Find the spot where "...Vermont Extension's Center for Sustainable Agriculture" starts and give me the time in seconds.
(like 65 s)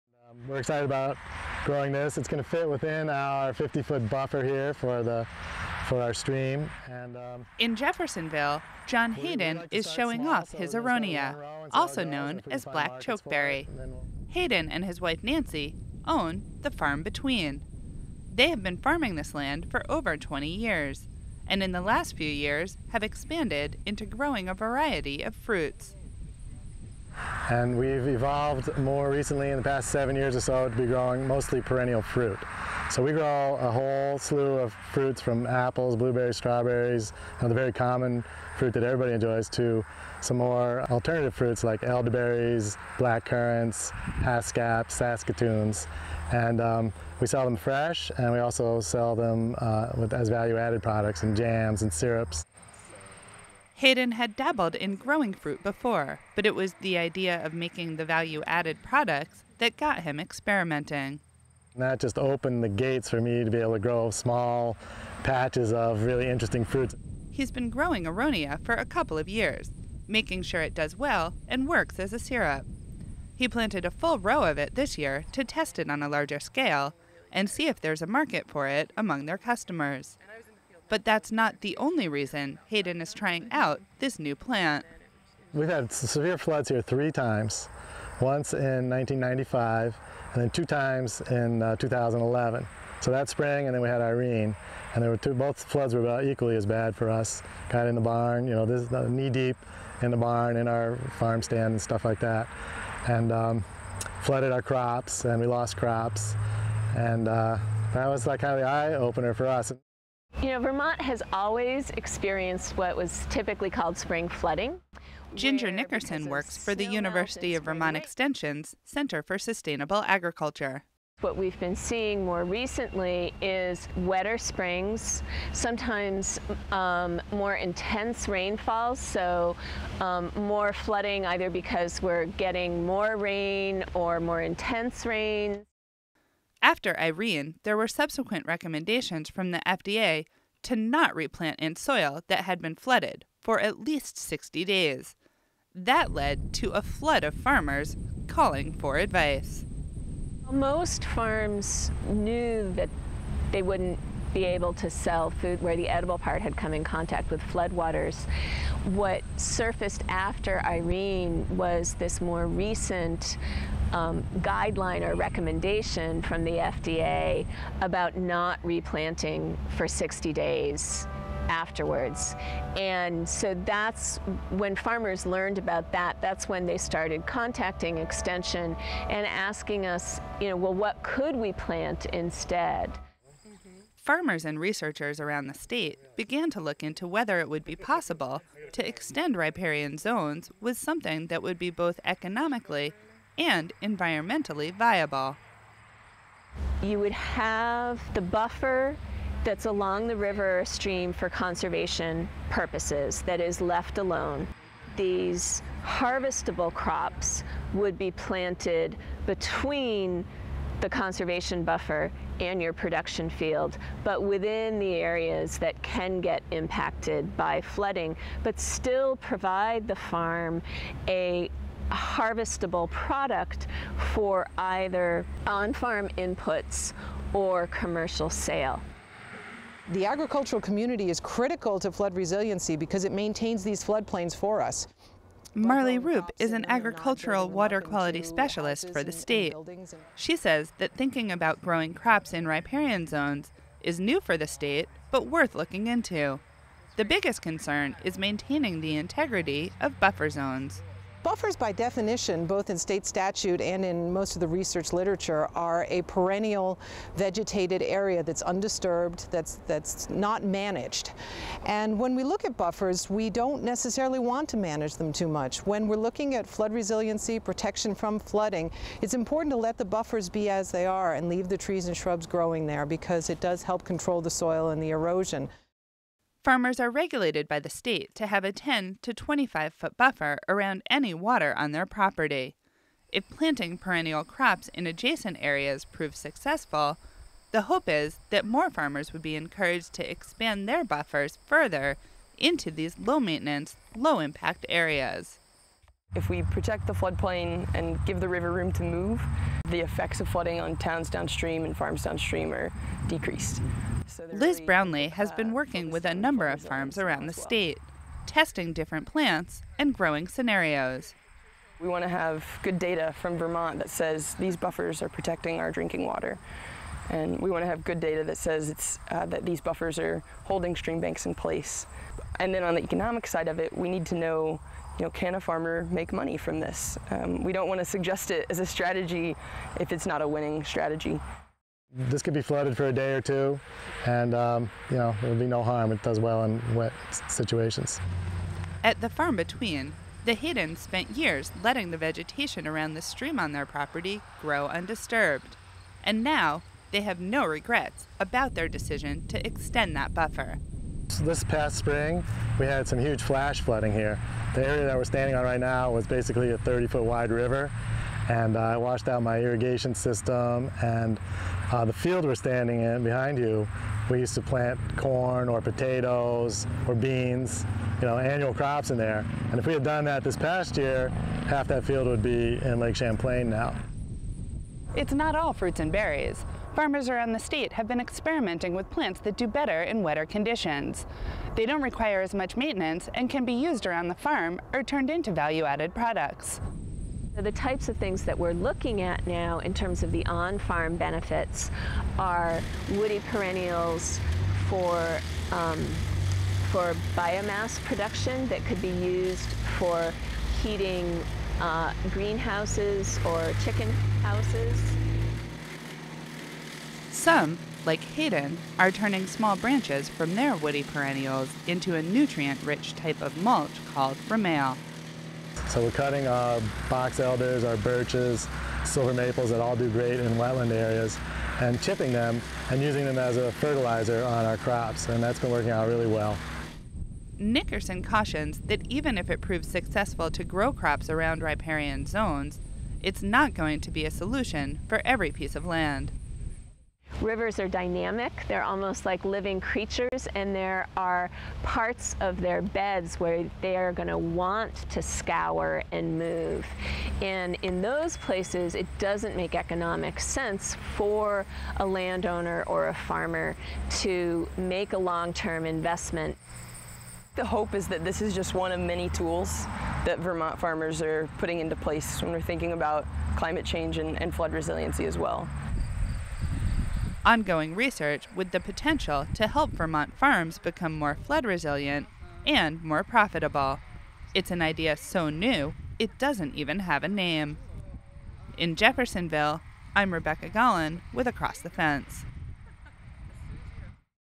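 117 s.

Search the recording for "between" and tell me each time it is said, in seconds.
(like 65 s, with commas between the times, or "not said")
17 s, 209 s, 339 s.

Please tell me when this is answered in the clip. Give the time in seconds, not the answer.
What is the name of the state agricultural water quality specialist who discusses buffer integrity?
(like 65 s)
235 s.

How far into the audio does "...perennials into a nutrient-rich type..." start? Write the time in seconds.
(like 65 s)
410 s.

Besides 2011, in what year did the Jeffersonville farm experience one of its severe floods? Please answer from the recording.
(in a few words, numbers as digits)
1995.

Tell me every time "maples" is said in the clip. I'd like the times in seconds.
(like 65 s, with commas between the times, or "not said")
419 s.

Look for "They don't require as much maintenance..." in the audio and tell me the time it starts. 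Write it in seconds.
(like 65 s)
381 s.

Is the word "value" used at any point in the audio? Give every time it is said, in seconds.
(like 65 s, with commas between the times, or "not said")
50 s, 58 s, 385 s.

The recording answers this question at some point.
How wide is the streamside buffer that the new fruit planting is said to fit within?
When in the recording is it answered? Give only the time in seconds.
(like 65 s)
3 s.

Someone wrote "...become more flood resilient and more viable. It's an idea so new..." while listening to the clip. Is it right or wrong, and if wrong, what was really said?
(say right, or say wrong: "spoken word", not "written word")
wrong: "profitable", not "viable".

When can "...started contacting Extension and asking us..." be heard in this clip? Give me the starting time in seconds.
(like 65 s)
176 s.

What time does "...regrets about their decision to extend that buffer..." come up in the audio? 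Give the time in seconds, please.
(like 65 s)
347 s.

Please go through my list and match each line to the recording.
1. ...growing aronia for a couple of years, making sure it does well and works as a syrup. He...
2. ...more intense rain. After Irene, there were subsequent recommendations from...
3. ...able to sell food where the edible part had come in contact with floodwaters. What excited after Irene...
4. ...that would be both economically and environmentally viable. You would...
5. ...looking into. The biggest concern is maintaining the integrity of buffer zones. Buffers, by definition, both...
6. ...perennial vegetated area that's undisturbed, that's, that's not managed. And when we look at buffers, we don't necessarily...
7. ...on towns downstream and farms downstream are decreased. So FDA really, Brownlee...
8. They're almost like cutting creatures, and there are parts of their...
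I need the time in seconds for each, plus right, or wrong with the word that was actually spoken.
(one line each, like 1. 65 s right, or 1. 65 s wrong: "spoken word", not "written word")
1. 67 s right
2. 134 s right
3. 154 s wrong: "surfaced", not "excited"
4. 191 s right
5. 245 s right
6. 256 s right
7. 300 s wrong: "Liz", not "FDA"
8. 438 s wrong: "living", not "cutting".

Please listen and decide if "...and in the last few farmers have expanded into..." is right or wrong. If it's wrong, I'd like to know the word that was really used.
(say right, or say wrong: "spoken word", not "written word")
wrong: "years", not "farmers".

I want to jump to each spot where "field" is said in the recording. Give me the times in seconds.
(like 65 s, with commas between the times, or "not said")
213 s, 361 s, 371 s.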